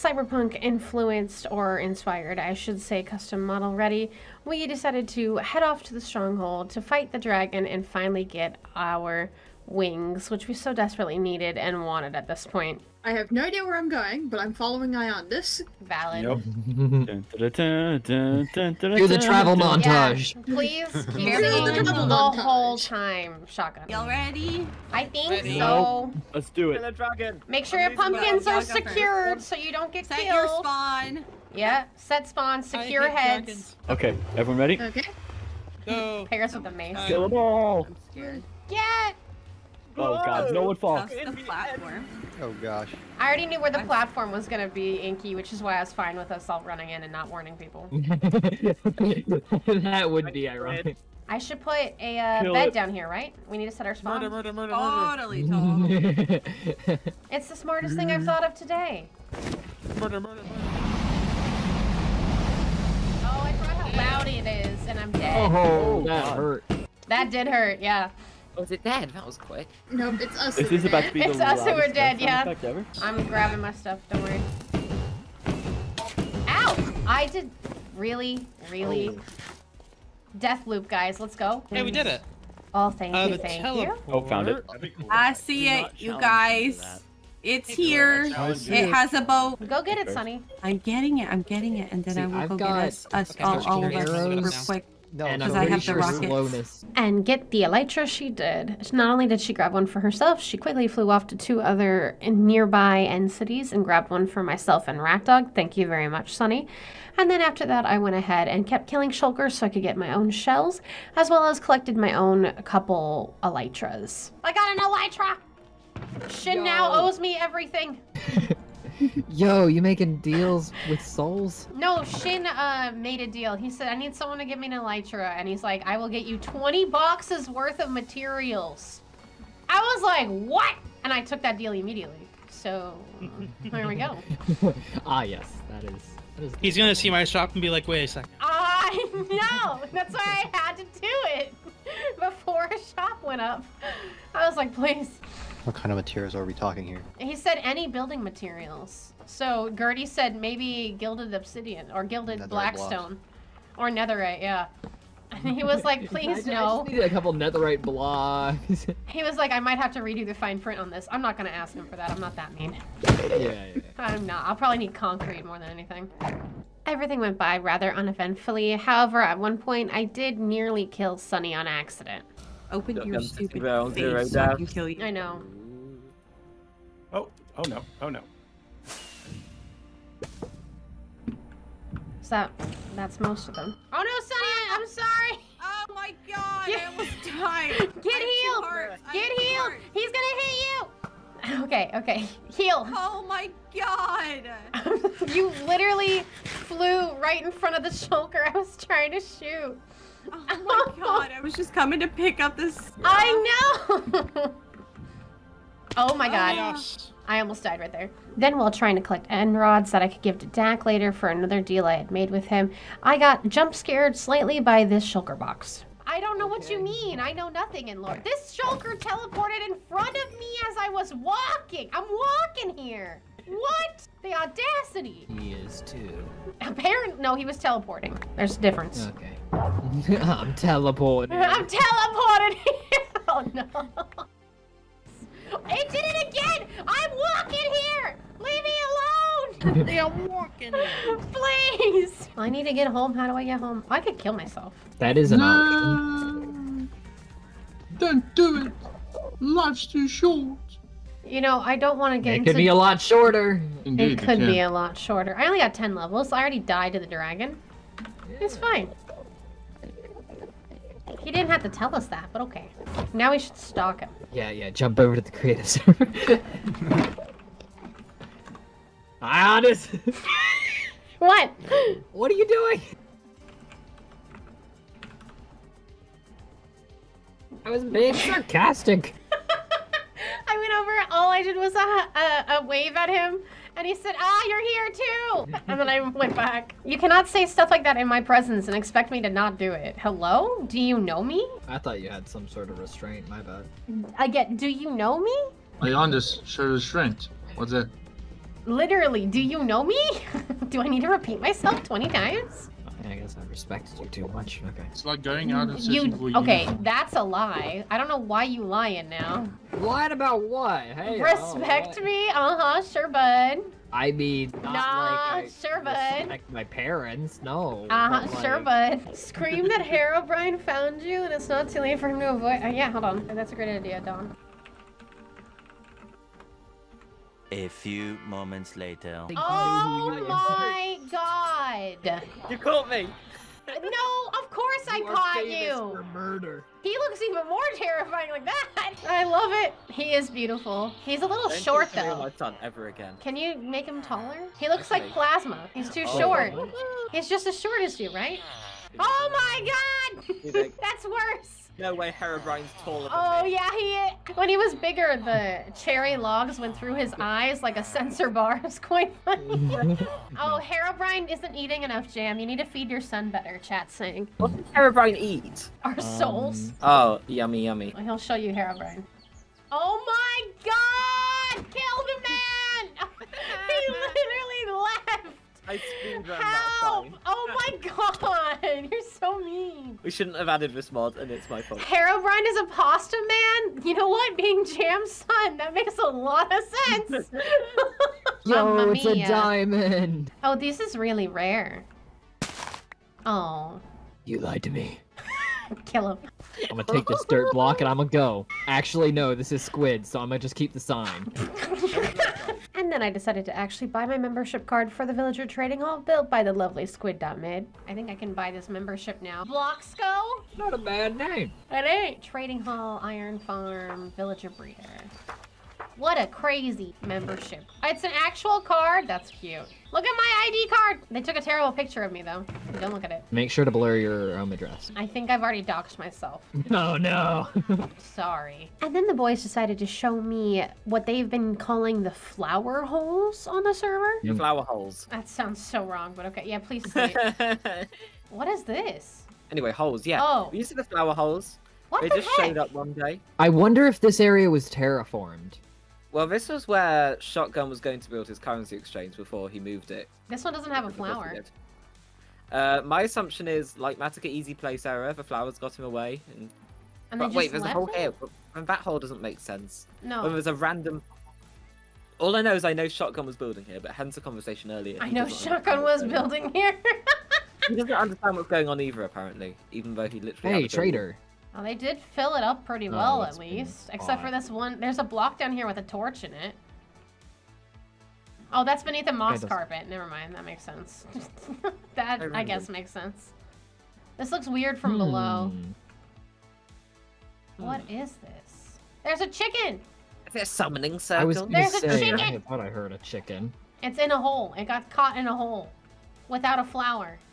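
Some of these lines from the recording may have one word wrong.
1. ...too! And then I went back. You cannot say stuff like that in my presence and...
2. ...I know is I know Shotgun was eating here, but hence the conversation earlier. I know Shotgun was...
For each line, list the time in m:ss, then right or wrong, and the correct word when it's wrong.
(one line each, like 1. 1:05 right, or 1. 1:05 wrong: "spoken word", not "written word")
1. 4:44 right
2. 7:42 wrong: "building", not "eating".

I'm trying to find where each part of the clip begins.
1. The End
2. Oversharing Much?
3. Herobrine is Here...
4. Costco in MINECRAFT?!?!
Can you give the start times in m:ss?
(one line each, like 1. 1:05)
1. 0:35
2. 4:18
3. 5:18
4. 6:42.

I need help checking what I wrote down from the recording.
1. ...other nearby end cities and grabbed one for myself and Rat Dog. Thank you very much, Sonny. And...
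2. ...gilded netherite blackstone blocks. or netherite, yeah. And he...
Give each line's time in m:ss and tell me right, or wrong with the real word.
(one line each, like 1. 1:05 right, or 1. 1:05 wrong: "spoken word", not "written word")
1. 1:41 right
2. 2:32 right.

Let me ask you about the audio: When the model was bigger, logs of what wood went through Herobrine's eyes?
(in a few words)
Cherry.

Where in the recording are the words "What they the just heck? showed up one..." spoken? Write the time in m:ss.
7:21.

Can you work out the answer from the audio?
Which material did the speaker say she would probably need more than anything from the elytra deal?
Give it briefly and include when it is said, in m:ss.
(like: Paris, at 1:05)
Concrete, at 2:44.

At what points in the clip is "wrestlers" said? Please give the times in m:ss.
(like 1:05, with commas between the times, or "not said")
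not said.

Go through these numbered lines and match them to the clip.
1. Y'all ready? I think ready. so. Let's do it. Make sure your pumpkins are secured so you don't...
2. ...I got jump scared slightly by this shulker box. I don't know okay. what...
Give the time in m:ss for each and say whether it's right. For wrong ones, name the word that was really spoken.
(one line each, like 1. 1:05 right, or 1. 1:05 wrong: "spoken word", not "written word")
1. 0:23 right
2. 3:33 right.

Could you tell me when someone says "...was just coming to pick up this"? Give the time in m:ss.
3:21.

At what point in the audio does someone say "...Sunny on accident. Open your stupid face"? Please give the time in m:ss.
2:51.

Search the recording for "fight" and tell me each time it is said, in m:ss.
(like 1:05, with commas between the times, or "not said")
0:06.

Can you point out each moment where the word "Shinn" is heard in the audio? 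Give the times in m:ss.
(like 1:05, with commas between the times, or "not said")
1:56, 2:02.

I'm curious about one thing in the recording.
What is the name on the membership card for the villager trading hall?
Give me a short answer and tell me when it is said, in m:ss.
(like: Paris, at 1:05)
Bloxco, at 6:49.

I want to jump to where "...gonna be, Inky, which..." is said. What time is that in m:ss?
0:44.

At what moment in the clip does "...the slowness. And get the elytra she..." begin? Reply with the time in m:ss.
1:35.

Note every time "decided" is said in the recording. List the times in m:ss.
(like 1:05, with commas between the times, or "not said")
0:04, 6:43, 7:09.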